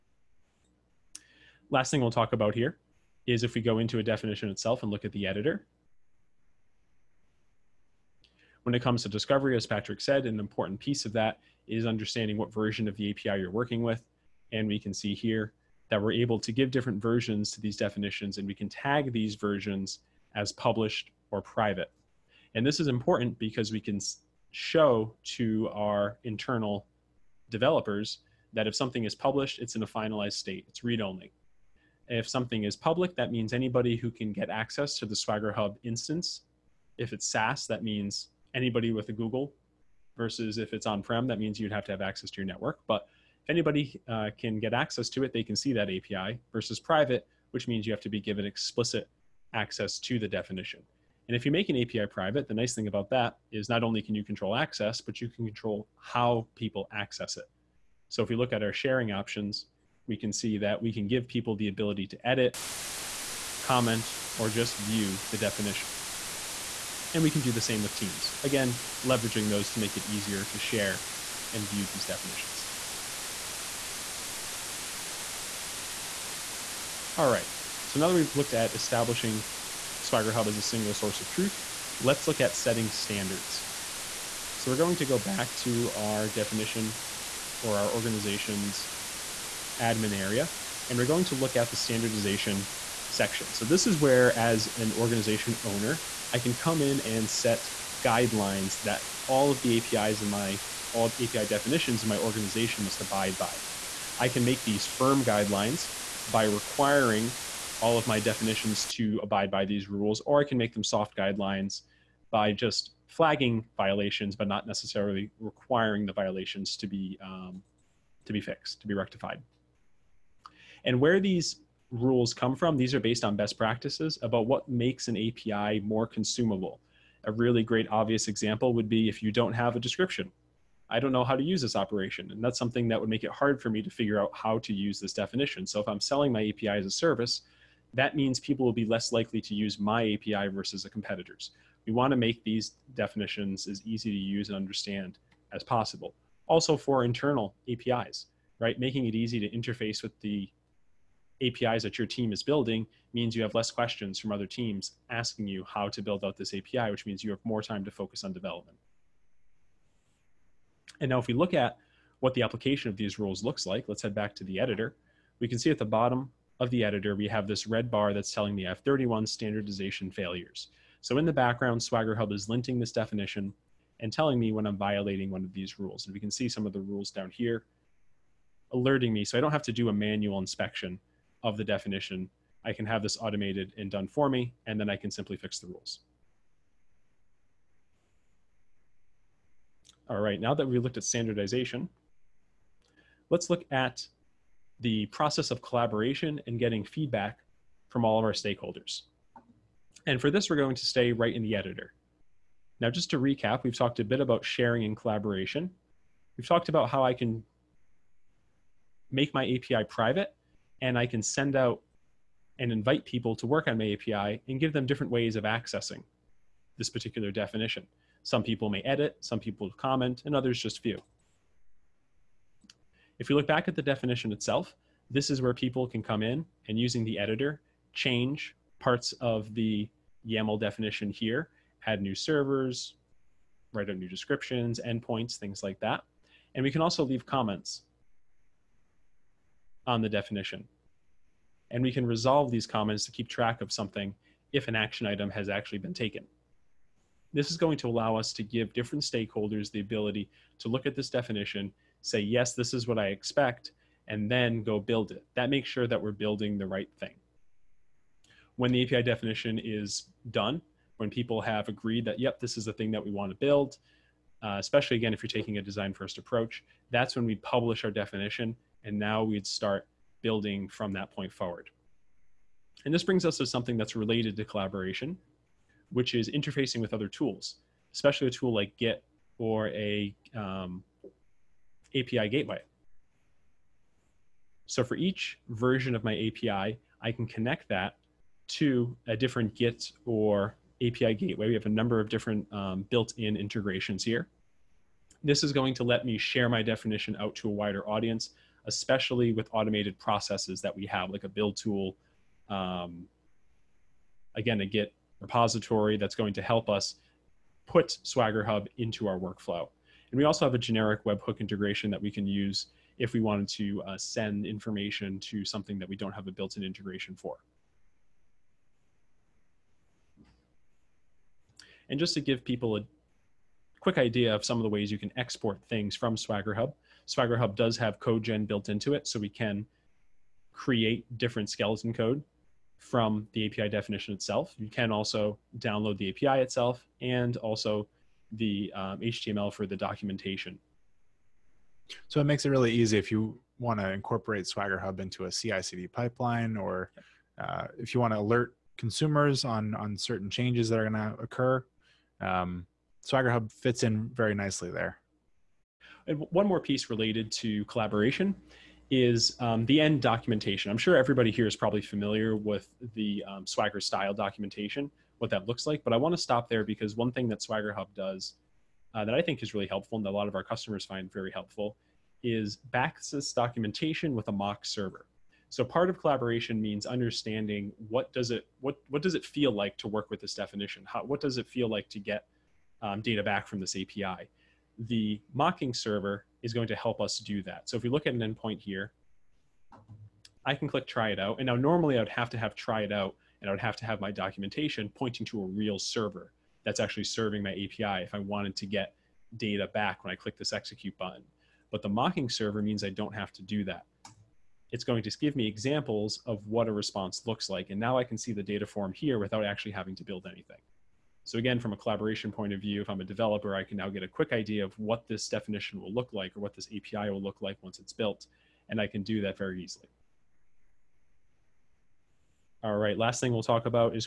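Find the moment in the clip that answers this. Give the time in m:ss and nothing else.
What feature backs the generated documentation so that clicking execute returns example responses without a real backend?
6:14.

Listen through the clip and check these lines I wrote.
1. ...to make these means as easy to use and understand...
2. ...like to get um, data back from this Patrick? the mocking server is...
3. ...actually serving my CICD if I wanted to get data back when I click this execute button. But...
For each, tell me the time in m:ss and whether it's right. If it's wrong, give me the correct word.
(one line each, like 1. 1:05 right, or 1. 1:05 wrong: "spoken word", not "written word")
1. 2:22 wrong: "definitions", not "means"
2. 6:21 wrong: "API", not "Patrick"
3. 6:36 wrong: "API", not "CICD".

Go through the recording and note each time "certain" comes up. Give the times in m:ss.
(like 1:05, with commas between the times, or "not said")
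5:49.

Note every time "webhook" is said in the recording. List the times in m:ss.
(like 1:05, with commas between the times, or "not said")
5:11.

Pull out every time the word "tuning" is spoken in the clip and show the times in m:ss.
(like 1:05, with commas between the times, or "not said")
not said.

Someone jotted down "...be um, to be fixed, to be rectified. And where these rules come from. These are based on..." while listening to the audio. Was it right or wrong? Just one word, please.
right.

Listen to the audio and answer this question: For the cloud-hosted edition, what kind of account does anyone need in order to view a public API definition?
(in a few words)
Google.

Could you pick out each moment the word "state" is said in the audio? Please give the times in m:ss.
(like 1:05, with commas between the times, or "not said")
0:30.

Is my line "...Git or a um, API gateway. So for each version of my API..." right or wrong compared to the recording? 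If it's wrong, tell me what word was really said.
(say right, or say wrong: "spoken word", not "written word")
right.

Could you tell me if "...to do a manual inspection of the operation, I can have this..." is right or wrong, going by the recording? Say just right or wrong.
wrong.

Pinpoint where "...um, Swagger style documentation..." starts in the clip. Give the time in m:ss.
6:03.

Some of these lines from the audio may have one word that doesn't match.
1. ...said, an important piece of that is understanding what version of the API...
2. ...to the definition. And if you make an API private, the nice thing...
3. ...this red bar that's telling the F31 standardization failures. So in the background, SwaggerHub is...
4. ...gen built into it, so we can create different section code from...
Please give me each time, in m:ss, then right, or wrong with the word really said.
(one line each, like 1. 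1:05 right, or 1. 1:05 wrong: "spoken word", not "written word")
1. 0:10 right
2. 0:49 right
3. 2:47 right
4. 5:28 wrong: "skeleton", not "section".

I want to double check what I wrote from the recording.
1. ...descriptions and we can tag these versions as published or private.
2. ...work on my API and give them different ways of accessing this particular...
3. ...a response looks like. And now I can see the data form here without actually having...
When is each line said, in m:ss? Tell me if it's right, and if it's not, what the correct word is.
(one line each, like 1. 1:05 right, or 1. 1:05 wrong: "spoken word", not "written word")
1. 0:17 wrong: "definitions", not "descriptions"
2. 3:33 right
3. 6:46 right.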